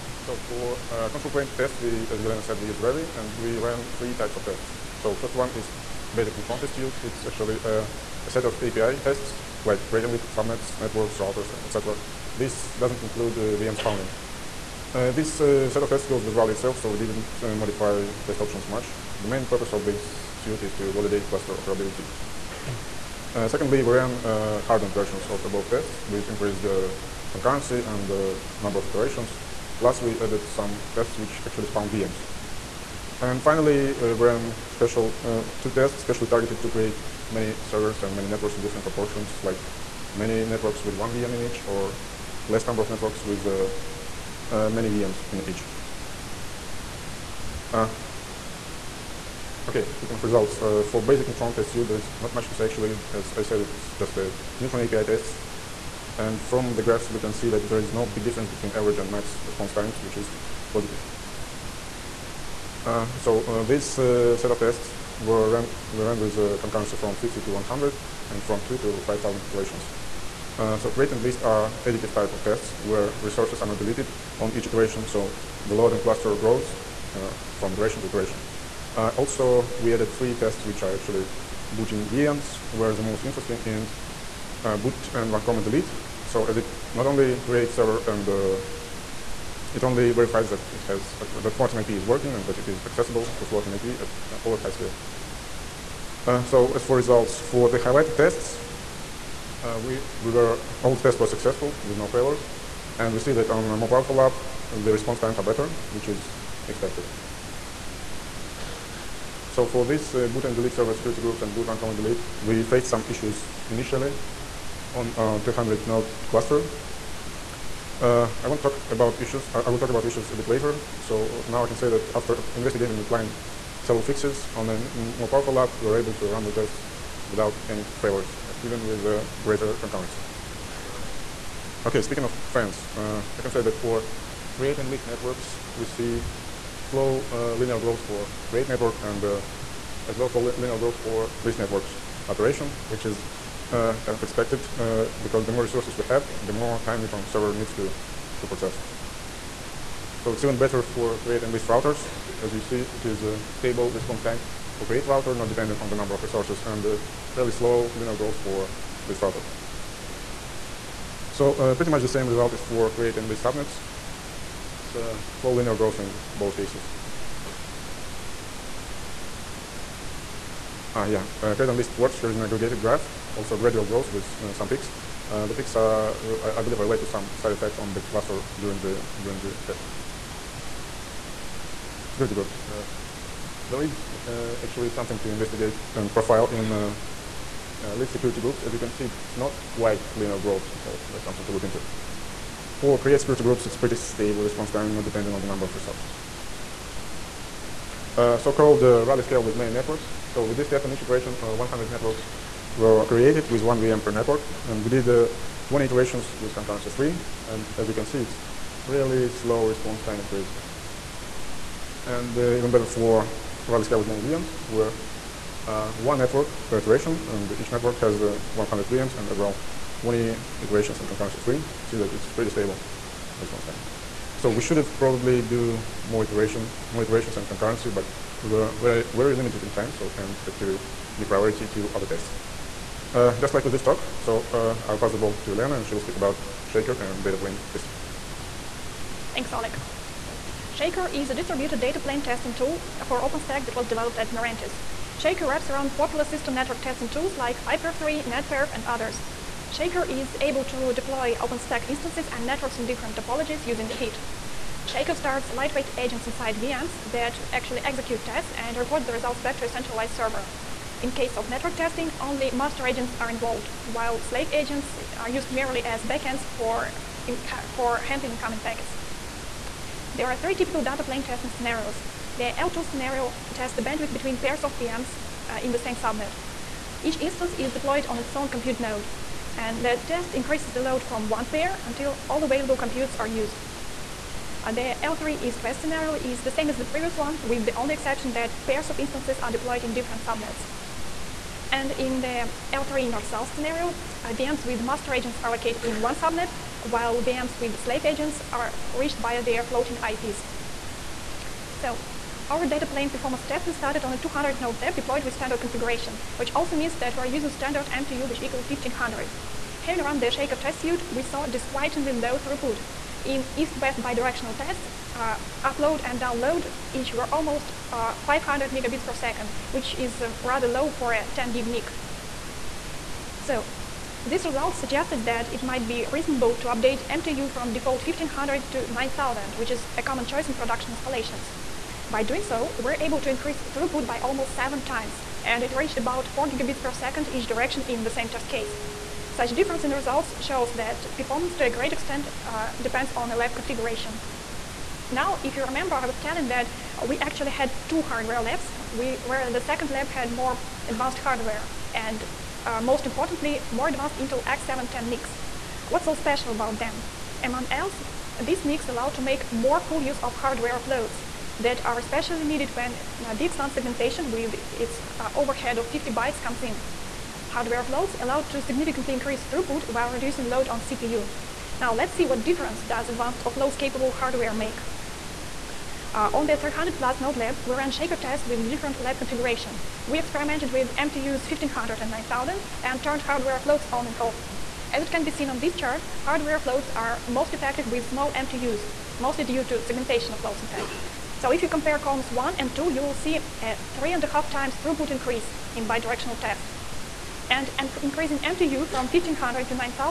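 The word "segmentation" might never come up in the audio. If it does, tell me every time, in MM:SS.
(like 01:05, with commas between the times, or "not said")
06:03, 06:29.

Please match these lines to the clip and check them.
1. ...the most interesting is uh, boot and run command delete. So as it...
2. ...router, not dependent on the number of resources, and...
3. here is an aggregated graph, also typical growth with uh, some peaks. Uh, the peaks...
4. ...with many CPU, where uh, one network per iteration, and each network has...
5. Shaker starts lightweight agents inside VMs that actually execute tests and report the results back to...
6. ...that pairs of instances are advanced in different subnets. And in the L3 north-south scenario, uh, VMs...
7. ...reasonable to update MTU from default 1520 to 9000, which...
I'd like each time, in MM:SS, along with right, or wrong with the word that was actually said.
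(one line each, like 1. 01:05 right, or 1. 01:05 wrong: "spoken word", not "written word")
1. 01:22 right
2. 02:35 right
3. 02:52 wrong: "gradual", not "typical"
4. 03:33 wrong: "VMs", not "CPU"
5. 04:14 right
6. 04:48 wrong: "deployed", not "advanced"
7. 05:26 wrong: "1500", not "1520".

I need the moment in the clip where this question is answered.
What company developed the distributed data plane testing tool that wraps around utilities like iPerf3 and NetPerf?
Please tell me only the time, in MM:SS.
04:04.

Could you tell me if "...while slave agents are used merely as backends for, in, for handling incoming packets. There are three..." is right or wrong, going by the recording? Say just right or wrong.
right.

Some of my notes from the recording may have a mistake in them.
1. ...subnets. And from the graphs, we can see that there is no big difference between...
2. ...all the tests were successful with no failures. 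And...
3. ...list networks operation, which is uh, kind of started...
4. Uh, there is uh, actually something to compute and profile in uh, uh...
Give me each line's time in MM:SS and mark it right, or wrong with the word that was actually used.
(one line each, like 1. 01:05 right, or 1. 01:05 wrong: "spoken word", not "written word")
1. 00:55 wrong: "tests", not "subnets"
2. 01:40 right
3. 02:21 wrong: "expected", not "started"
4. 03:02 wrong: "investigate", not "compute".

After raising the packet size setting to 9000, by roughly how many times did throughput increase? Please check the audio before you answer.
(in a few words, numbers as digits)
7.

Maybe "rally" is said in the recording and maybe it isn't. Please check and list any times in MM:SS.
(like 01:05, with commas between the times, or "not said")
00:02, 00:16, 03:19, 03:33.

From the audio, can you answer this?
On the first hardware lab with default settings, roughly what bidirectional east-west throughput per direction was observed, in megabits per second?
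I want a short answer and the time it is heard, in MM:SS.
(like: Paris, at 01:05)
500, at 05:18.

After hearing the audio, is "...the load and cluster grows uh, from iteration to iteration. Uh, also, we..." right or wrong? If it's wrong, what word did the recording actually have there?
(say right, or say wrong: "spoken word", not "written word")
right.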